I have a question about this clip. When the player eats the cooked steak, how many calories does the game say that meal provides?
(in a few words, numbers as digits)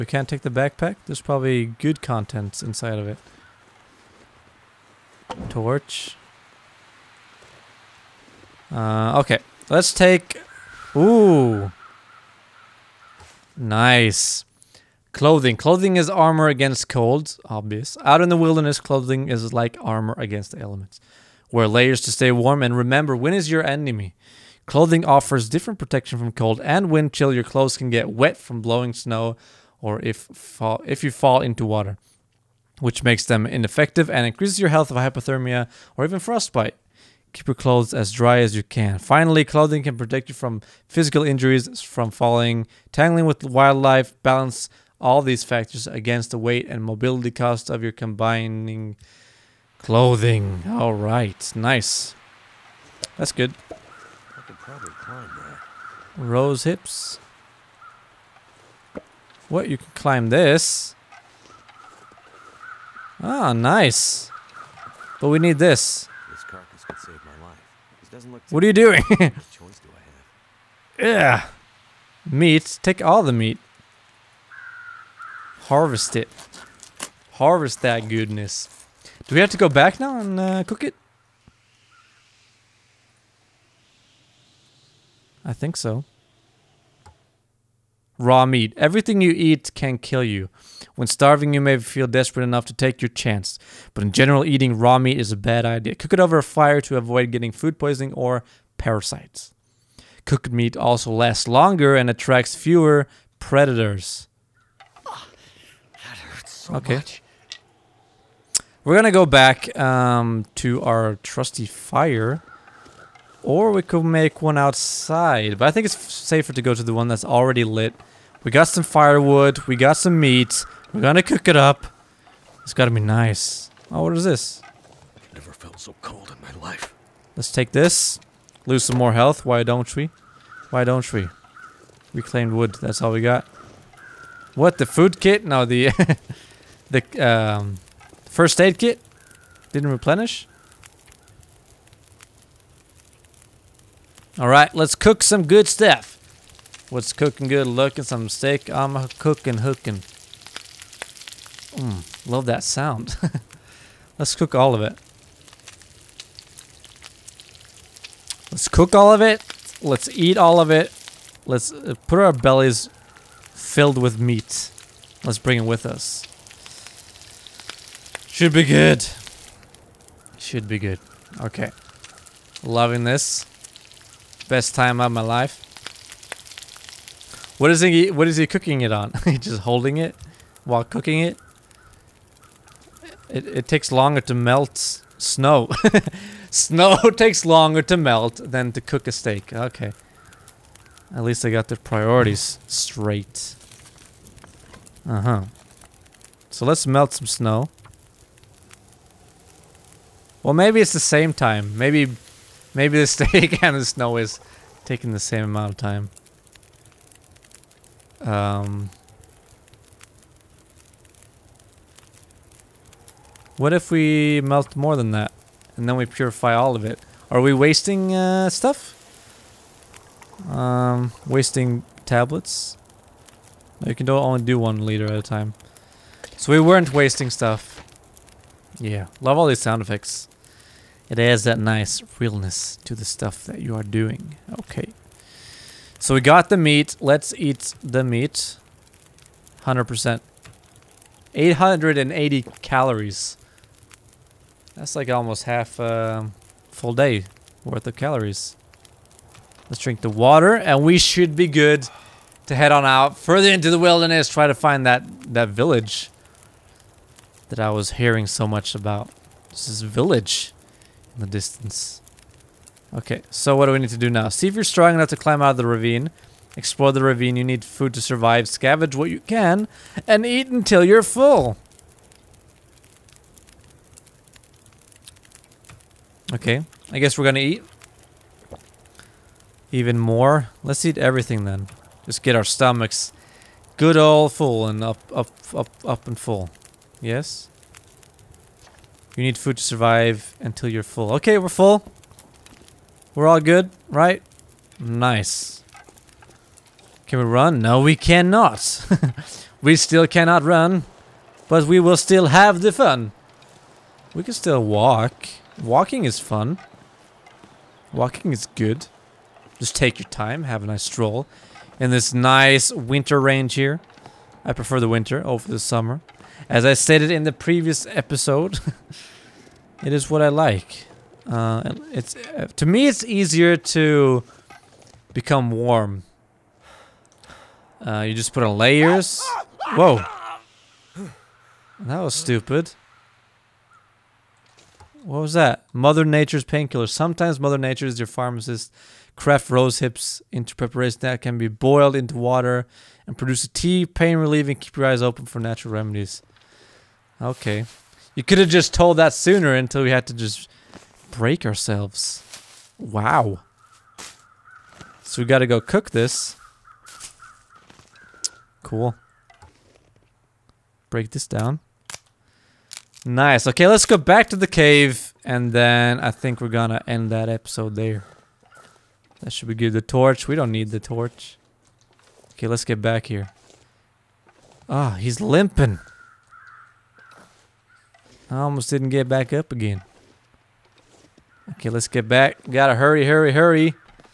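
880.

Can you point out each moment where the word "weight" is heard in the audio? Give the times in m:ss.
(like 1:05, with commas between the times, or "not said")
0:46.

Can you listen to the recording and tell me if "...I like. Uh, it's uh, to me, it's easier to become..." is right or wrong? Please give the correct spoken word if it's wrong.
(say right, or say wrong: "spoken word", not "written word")
right.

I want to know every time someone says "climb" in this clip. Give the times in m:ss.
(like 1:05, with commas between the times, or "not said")
0:55, 0:59, 4:25.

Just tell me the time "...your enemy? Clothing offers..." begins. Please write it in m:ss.
0:23.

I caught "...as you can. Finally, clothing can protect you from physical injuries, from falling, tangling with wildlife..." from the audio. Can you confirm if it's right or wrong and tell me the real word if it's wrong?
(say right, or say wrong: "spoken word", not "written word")
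right.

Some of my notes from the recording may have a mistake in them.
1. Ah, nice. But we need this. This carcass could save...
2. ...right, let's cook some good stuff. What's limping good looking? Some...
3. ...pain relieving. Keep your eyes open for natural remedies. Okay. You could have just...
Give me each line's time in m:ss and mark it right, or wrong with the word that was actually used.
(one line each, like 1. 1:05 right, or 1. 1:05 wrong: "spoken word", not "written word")
1. 1:03 right
2. 2:24 wrong: "cooking", not "limping"
3. 5:43 right.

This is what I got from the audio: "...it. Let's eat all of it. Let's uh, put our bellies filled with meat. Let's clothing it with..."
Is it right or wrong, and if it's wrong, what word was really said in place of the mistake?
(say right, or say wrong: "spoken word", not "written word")
wrong: "bring", not "clothing".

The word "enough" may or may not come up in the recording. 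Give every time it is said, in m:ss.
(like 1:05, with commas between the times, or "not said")
1:32, 4:24.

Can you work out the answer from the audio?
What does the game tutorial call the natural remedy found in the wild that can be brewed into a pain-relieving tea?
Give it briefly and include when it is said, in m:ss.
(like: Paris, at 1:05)
Mother Nature's painkiller, at 5:35.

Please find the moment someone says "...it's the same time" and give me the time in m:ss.
3:20.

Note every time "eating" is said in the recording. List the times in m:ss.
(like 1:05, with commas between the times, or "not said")
1:34.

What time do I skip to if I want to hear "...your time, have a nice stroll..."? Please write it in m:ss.
5:09.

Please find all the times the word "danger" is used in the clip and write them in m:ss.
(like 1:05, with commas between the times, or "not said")
not said.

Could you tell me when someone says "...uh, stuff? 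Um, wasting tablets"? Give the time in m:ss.
3:38.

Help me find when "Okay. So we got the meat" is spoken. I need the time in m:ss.
3:54.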